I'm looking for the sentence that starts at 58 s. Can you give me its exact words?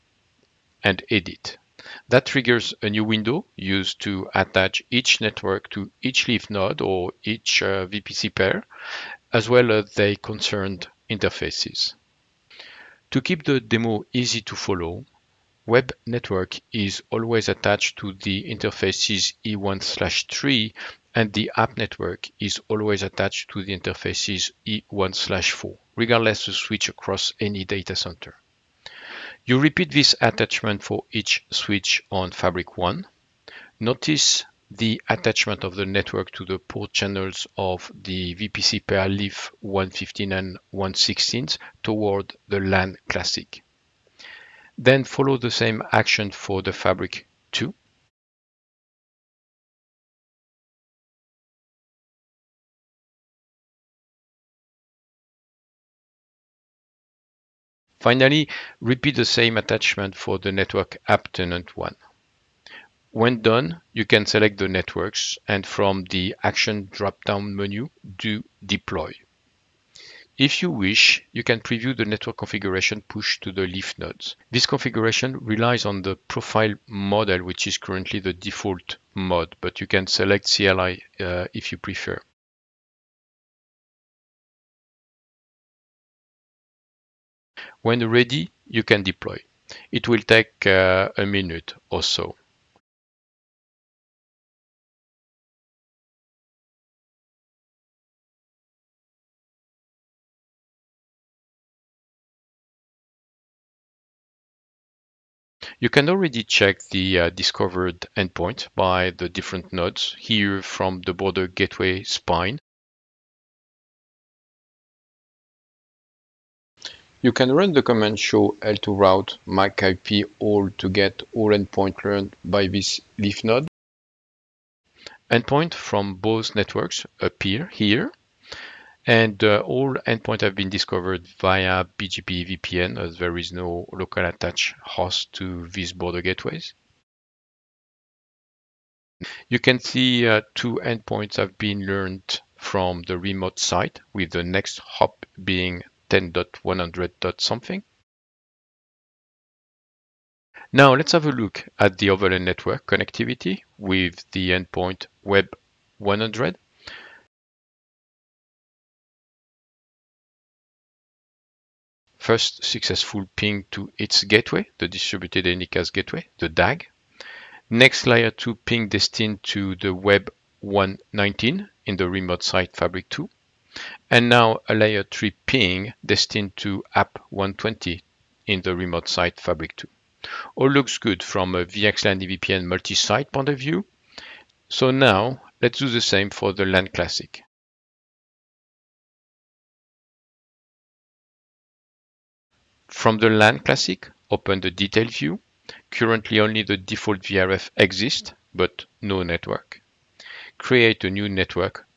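Finally, repeat the same attachment for the network app tenant one.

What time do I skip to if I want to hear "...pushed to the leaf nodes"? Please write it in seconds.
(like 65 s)
73 s.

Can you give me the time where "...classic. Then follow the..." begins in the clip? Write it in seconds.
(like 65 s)
43 s.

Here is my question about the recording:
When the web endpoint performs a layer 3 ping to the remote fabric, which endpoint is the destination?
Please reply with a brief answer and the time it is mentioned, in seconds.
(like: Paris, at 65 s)
app 120, at 176 s.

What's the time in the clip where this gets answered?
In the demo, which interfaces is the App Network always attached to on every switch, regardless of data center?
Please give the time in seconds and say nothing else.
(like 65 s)
24 s.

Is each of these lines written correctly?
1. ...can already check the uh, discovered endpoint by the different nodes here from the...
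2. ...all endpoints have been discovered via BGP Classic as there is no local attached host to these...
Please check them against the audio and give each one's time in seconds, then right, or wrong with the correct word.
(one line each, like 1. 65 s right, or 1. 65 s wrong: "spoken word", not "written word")
1. 105 s right
2. 129 s wrong: "EVPN", not "Classic".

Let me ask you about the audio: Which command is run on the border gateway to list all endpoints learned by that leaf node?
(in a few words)
show l2 route mac ip all.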